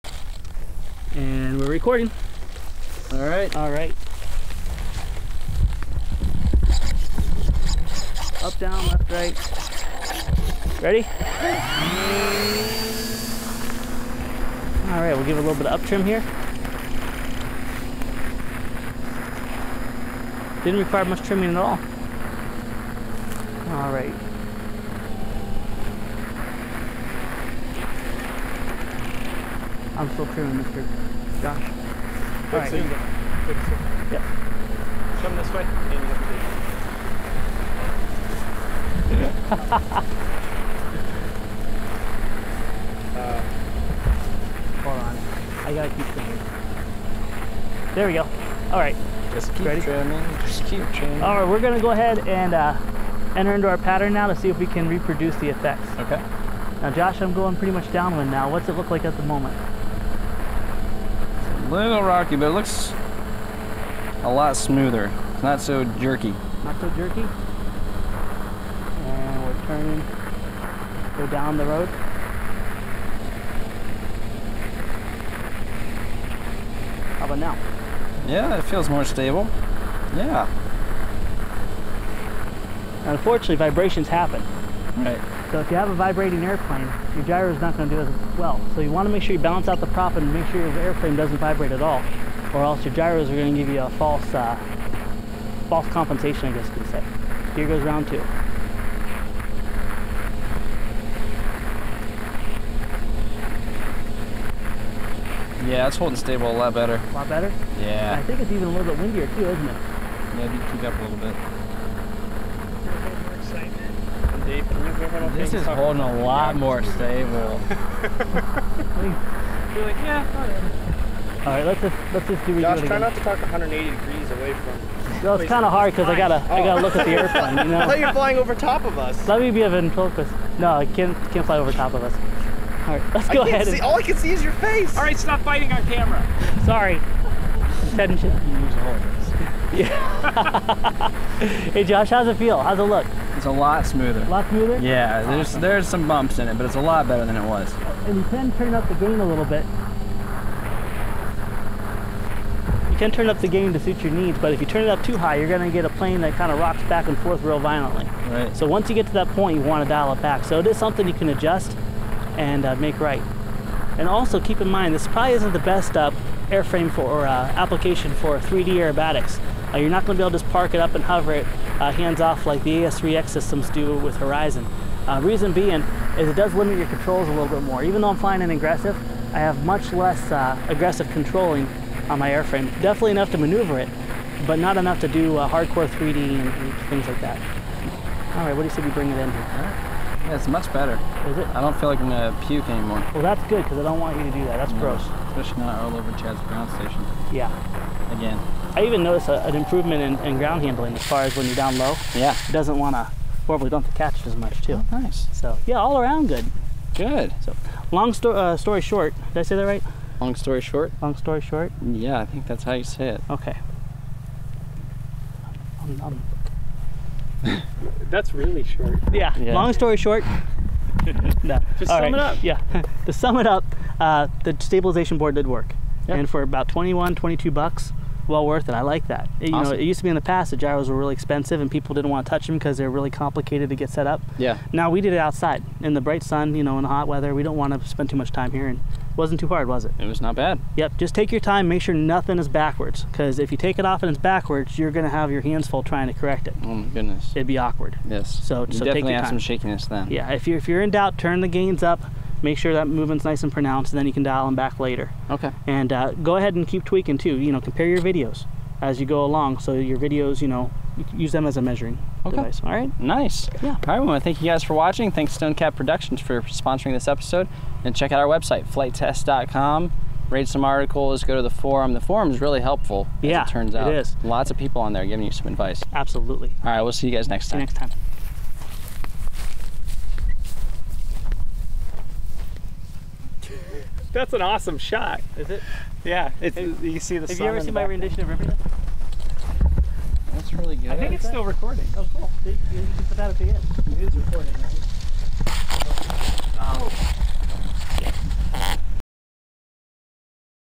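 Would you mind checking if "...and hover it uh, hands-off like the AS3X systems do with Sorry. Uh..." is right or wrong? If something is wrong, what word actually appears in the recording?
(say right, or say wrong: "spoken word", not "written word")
wrong: "Horizon", not "Sorry".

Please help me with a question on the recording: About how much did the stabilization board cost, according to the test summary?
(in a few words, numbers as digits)
21 to 22 dollars.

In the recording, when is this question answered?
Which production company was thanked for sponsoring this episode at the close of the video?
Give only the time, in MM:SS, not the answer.
04:25.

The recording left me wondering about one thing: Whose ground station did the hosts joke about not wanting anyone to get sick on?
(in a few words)
Chad's.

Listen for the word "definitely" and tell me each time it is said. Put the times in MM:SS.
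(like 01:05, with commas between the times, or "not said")
03:02, 04:08.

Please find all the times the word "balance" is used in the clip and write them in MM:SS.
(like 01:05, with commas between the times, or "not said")
01:29.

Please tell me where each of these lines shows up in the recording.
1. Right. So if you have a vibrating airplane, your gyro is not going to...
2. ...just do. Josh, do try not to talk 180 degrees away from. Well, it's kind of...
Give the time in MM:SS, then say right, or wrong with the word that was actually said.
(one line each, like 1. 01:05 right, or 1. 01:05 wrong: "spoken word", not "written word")
1. 01:24 right
2. 02:02 right.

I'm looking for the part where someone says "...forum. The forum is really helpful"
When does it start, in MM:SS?
04:31.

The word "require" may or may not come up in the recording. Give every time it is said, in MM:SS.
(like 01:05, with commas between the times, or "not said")
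00:20.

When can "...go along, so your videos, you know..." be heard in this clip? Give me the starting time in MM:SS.
04:19.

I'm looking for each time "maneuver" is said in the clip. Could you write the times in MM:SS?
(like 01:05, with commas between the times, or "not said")
03:03.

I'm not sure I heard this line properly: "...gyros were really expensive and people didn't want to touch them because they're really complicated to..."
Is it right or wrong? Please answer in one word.
right.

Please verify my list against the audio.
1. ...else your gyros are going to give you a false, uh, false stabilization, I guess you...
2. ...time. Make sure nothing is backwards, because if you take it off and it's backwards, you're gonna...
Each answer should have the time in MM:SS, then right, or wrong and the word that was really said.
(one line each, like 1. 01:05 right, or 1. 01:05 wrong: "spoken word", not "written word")
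1. 01:32 wrong: "compensation", not "stabilization"
2. 04:01 right.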